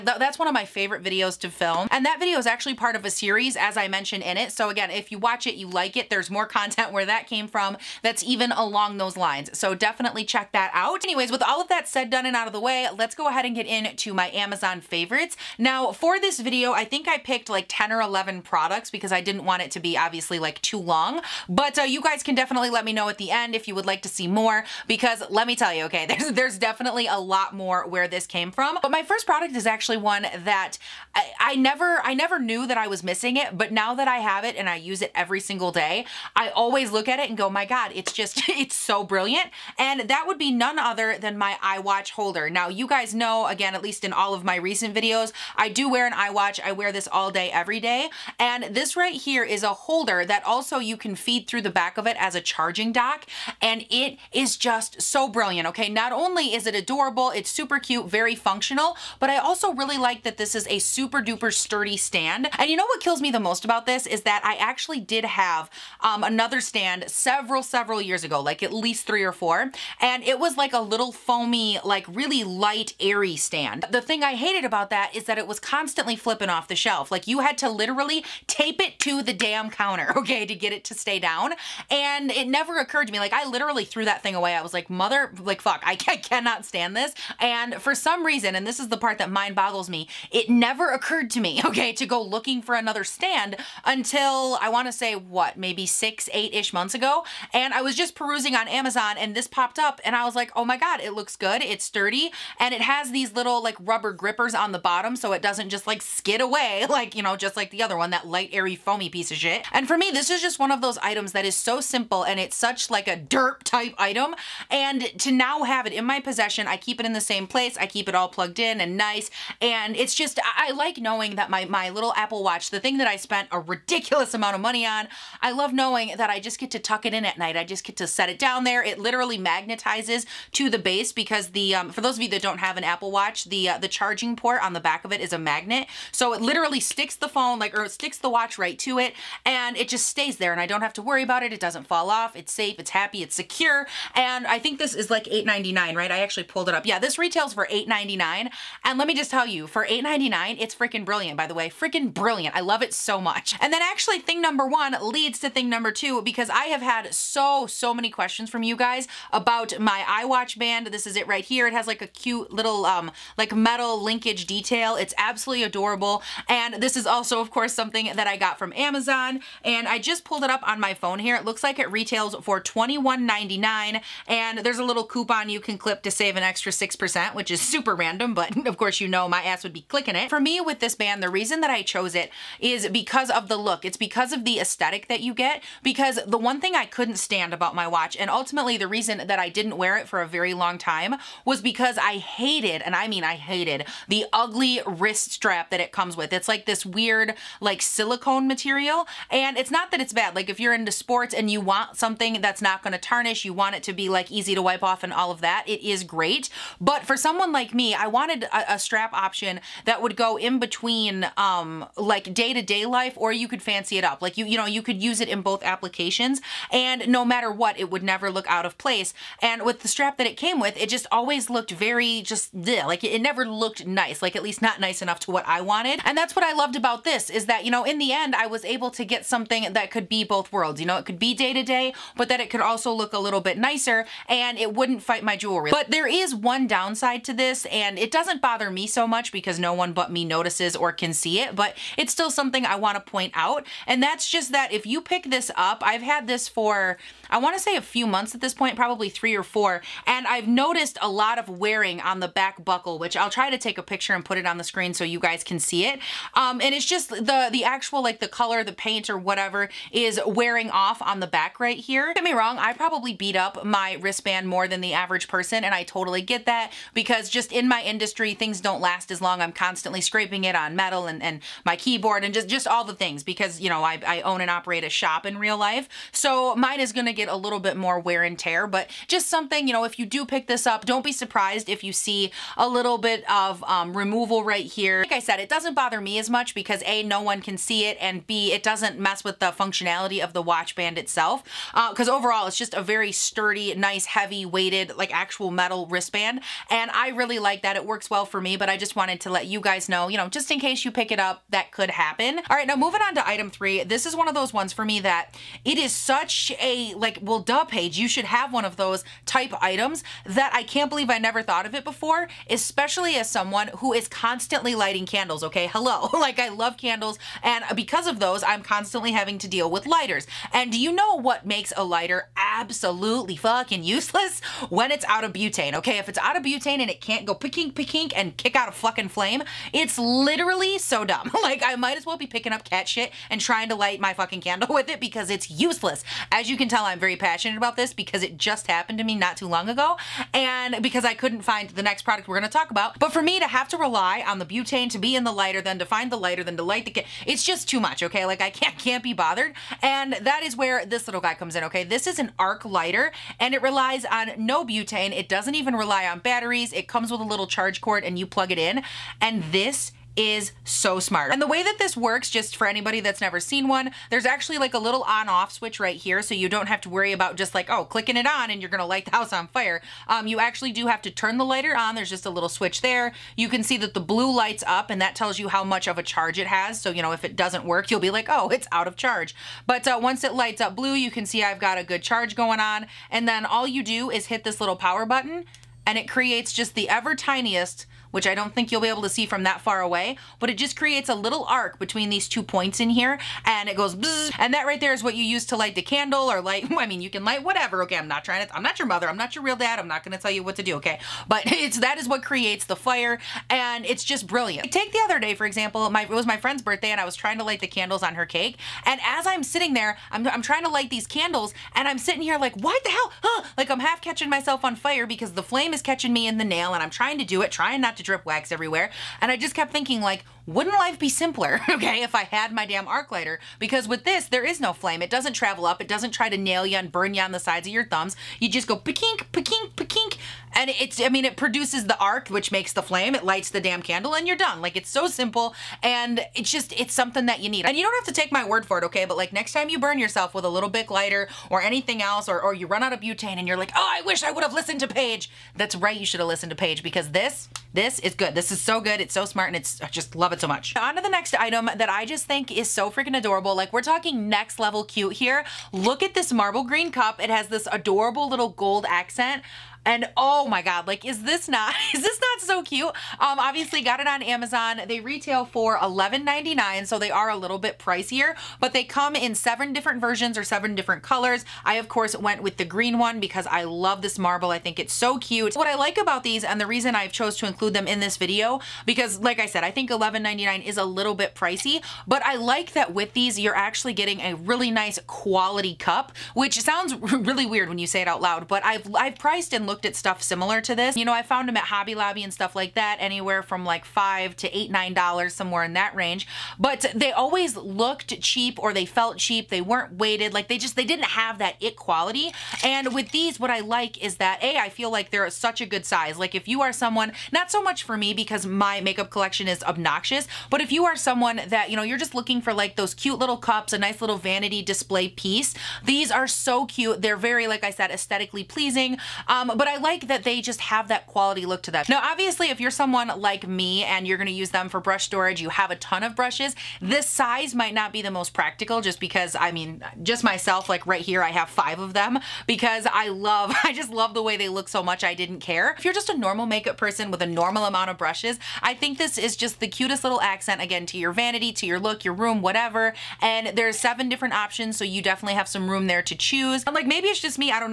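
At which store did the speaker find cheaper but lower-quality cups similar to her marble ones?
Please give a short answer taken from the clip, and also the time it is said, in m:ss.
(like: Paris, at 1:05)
Hobby Lobby, at 8:11.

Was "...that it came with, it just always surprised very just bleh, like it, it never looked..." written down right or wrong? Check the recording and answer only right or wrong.
wrong.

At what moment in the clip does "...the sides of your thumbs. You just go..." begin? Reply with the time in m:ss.
7:07.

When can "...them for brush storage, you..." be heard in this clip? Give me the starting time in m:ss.
8:44.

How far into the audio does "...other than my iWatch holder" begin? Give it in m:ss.
0:40.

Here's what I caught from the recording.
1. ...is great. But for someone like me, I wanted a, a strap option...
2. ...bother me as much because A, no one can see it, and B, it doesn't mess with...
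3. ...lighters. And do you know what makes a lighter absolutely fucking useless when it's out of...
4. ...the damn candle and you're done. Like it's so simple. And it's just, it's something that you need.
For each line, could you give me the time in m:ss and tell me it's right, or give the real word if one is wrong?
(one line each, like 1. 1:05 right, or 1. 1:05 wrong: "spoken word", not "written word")
1. 3:25 right
2. 4:45 right
3. 5:19 right
4. 7:13 right.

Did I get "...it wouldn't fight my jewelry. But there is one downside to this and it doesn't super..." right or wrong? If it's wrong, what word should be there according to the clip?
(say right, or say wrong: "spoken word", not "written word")
wrong: "bother", not "super".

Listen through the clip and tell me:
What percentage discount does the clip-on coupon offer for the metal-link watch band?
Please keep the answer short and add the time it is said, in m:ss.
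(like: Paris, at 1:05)
6%, at 2:56.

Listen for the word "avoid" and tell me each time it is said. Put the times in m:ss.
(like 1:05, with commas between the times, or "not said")
not said.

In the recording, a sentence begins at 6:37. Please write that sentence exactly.
I'm not trying to, I'm not your mother, I'm not your real dad, I'm not gonna tell you what to do, okay?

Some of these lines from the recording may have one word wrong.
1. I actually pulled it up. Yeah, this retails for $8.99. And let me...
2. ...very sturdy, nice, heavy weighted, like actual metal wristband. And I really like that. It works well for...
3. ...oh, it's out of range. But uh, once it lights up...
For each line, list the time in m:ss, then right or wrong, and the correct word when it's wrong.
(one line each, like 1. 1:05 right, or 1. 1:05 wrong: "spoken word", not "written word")
1. 2:26 right
2. 4:52 right
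3. 6:18 wrong: "charge", not "range".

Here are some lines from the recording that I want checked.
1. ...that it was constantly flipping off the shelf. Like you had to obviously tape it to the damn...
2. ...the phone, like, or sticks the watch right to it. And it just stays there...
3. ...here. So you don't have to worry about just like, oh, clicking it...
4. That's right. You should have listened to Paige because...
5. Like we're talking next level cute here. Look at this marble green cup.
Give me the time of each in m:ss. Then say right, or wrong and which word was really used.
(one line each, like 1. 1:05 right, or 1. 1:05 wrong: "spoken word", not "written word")
1. 1:15 wrong: "literally", not "obviously"
2. 2:17 right
3. 6:05 right
4. 7:25 right
5. 7:33 right.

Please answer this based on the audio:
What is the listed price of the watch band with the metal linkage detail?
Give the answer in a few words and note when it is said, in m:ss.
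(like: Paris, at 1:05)
$21.99, at 2:52.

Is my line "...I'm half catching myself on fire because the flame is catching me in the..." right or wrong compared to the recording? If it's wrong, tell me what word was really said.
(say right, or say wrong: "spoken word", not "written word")
right.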